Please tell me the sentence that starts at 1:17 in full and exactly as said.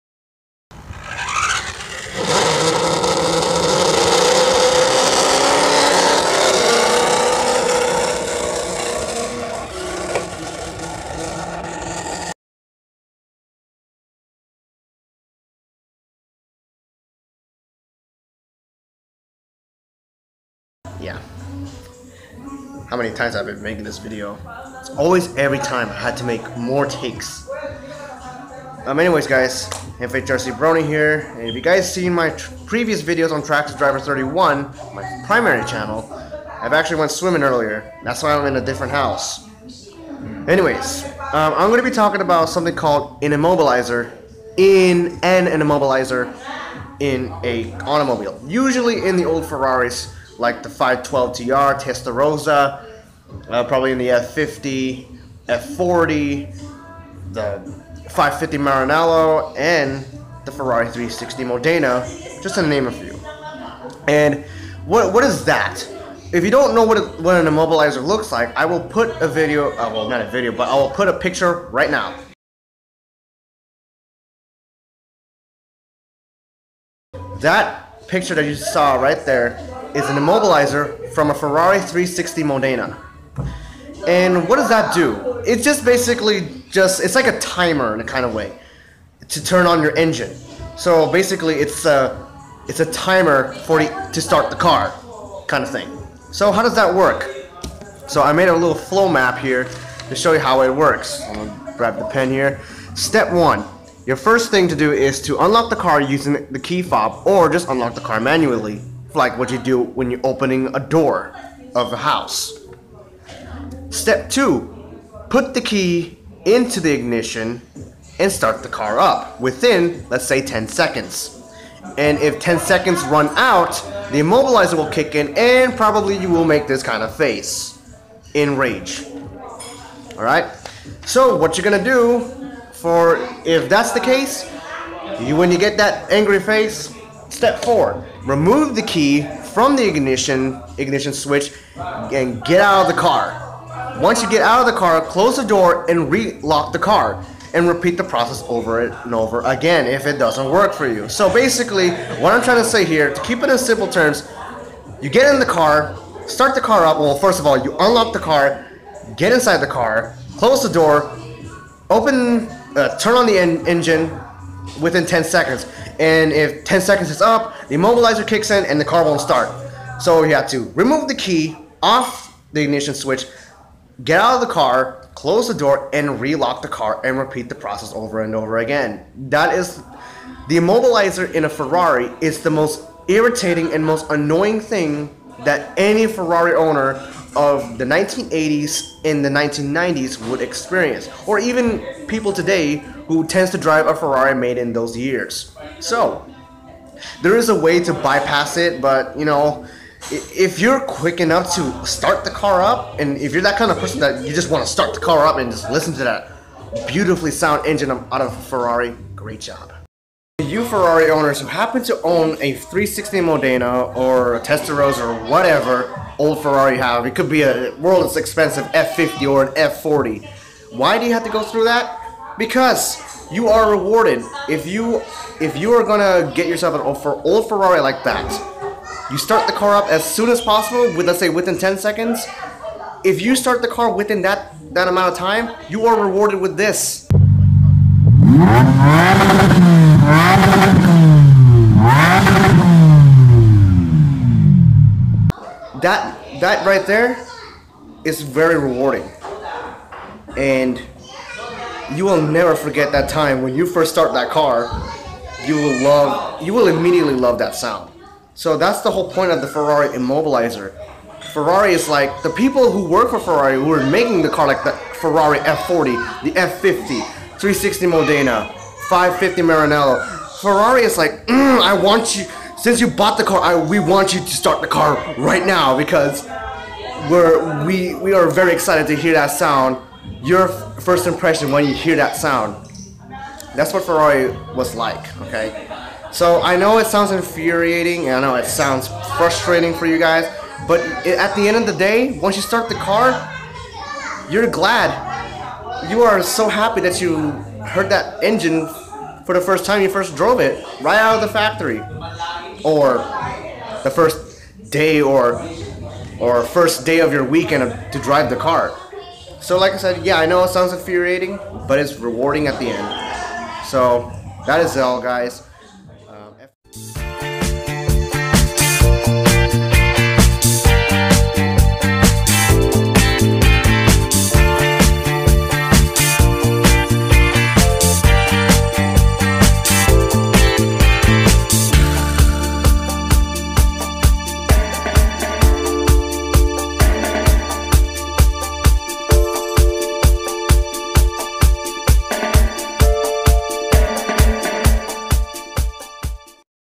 That picture that you saw right there is an immobilizer from a Ferrari 360 Modena.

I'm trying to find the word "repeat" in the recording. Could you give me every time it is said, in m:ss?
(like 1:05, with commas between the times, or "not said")
2:27, 2:57.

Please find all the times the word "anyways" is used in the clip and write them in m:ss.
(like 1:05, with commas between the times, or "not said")
0:28, 0:40.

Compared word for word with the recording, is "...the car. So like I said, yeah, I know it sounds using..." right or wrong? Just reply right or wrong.
wrong.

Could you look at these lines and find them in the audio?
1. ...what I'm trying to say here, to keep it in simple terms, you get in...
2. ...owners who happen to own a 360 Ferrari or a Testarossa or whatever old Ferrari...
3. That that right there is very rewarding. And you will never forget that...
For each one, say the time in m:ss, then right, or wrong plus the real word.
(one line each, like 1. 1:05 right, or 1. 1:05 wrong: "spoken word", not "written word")
1. 2:32 right
2. 3:31 wrong: "Modena", not "Ferrari"
3. 4:05 right.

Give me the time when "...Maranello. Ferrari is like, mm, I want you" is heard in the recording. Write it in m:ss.
4:29.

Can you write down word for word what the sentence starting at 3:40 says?
Why do you have to go through that?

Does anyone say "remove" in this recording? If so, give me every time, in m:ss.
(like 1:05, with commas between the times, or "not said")
2:18, 2:50.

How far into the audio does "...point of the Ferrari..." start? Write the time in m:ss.
4:19.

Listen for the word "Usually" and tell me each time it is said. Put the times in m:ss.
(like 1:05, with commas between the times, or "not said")
0:48.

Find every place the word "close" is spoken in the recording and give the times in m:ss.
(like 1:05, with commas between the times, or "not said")
2:25, 2:40, 2:55.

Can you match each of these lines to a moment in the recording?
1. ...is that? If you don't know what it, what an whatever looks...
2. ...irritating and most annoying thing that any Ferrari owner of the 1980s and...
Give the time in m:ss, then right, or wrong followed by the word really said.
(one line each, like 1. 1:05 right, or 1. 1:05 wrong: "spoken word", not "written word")
1. 1:05 wrong: "immobilizer", not "whatever"
2. 3:03 right.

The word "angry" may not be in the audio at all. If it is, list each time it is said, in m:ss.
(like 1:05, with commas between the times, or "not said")
2:16.